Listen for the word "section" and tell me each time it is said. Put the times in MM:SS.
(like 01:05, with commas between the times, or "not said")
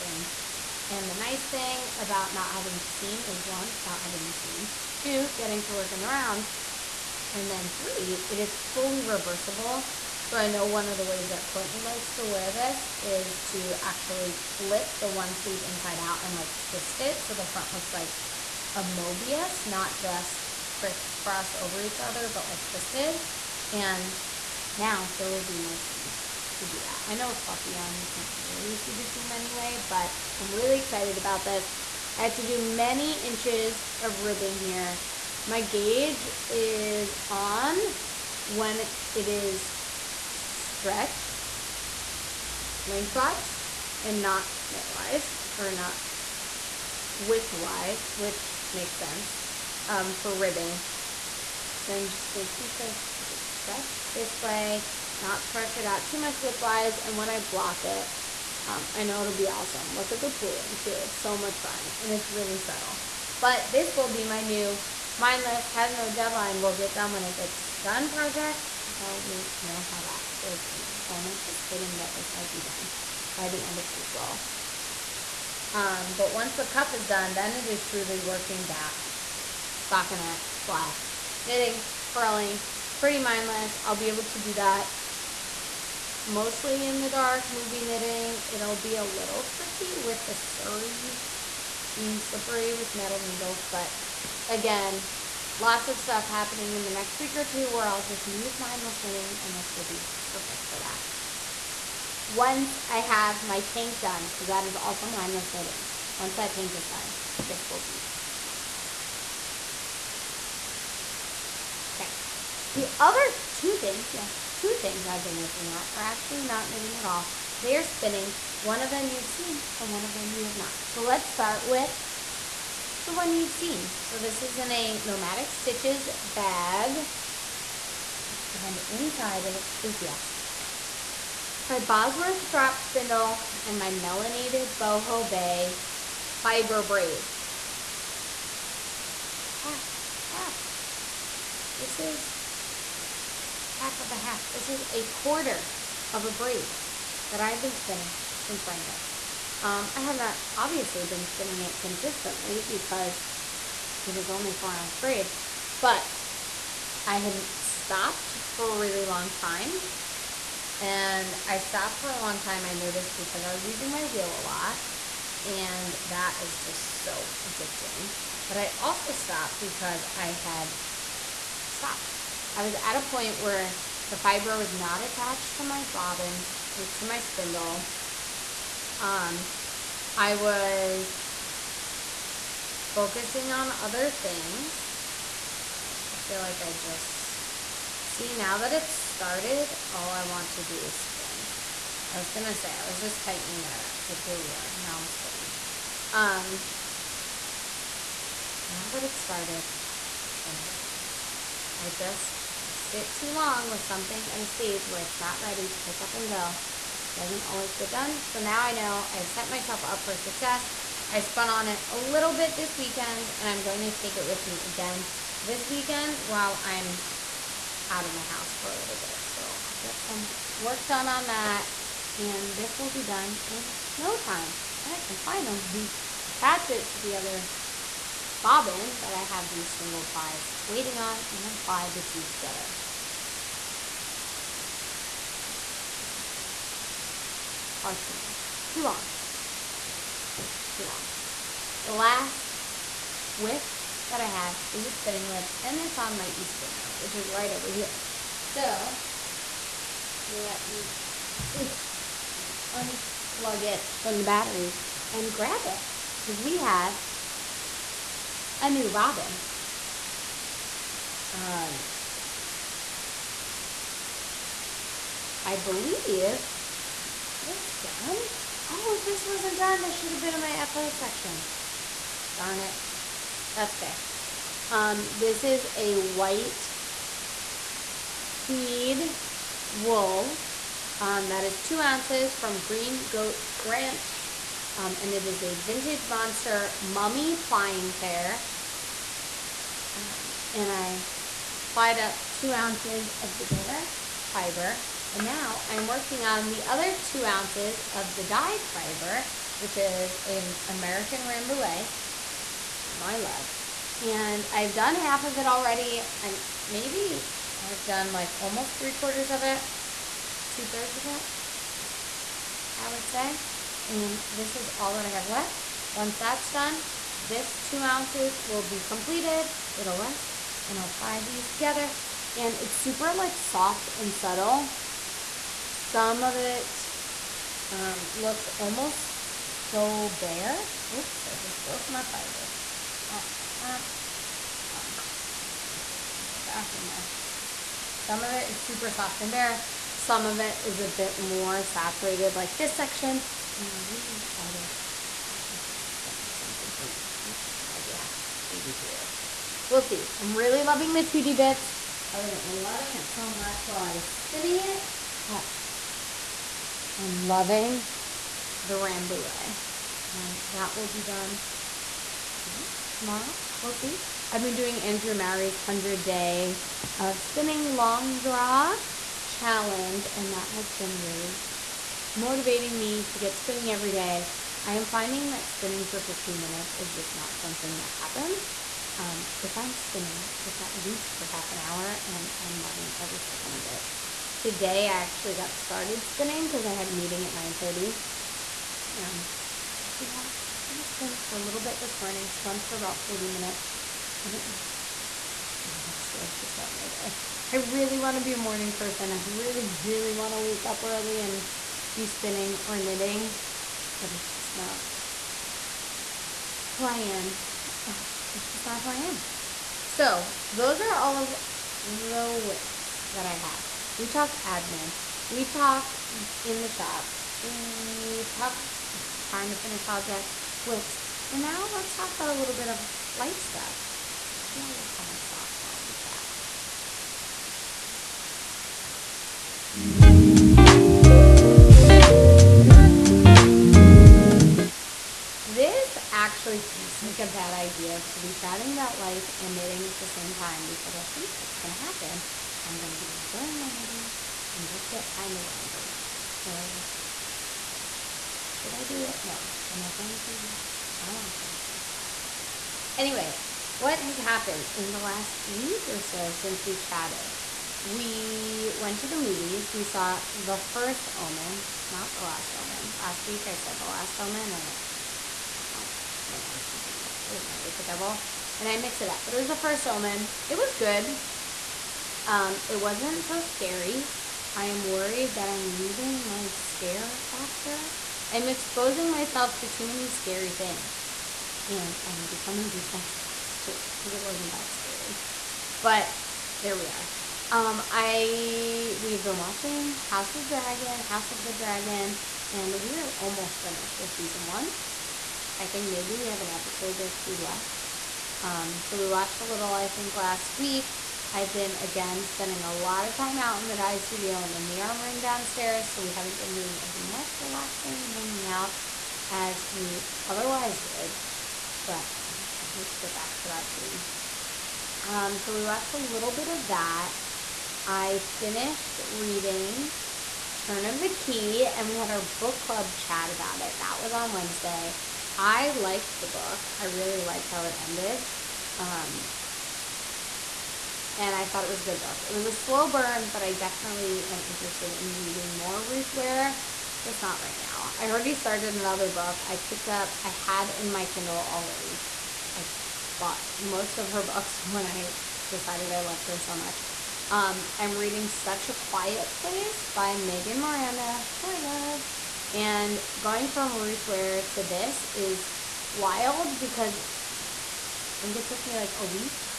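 04:30, 05:42.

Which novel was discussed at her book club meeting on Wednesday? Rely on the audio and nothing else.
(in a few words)
The Turn of the Key.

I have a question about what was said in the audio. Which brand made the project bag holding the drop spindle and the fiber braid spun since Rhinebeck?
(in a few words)
Nomadic Stitches.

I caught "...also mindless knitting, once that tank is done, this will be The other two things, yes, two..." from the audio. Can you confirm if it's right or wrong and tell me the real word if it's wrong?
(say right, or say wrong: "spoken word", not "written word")
right.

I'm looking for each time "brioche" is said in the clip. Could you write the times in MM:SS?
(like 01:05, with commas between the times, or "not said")
05:48.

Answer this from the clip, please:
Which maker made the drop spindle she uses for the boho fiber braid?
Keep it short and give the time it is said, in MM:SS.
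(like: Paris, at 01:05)
Bosworth, at 02:11.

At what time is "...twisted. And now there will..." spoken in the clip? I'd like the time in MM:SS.
00:22.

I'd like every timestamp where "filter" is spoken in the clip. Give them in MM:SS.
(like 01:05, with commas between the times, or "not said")
not said.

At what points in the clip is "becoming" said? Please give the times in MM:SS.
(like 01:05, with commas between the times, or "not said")
08:02.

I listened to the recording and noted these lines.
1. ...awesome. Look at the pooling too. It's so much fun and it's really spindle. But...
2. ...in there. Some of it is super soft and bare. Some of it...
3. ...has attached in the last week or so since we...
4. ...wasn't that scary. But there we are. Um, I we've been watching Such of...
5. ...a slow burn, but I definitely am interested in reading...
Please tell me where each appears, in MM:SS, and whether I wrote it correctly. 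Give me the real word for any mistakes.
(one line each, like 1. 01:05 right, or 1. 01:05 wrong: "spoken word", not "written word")
1. 00:59 wrong: "subtle", not "spindle"
2. 05:36 right
3. 07:33 wrong: "happened", not "attached"
4. 08:04 wrong: "House", not "Such"
5. 08:52 right.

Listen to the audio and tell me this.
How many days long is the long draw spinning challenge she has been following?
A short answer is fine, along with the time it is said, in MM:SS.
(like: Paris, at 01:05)
100, at 06:05.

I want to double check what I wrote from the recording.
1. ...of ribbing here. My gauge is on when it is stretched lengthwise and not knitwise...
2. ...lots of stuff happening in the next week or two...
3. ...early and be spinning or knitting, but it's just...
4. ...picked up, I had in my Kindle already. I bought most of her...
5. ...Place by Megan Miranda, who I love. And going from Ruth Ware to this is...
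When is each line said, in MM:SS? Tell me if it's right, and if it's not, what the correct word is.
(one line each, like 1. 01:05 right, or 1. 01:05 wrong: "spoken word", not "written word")
1. 00:34 right
2. 01:35 right
3. 06:40 right
4. 08:59 right
5. 09:09 right.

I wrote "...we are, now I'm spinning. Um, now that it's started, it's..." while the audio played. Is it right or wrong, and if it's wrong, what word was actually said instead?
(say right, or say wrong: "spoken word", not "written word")
right.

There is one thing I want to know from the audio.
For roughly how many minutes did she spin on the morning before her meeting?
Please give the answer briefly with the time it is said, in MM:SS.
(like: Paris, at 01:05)
40, at 06:32.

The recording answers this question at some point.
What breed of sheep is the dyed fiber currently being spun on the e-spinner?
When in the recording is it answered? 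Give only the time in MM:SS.
05:00.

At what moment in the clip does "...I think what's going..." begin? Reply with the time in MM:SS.
07:20.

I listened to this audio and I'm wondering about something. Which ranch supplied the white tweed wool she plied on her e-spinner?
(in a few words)
Green Goat Ranch.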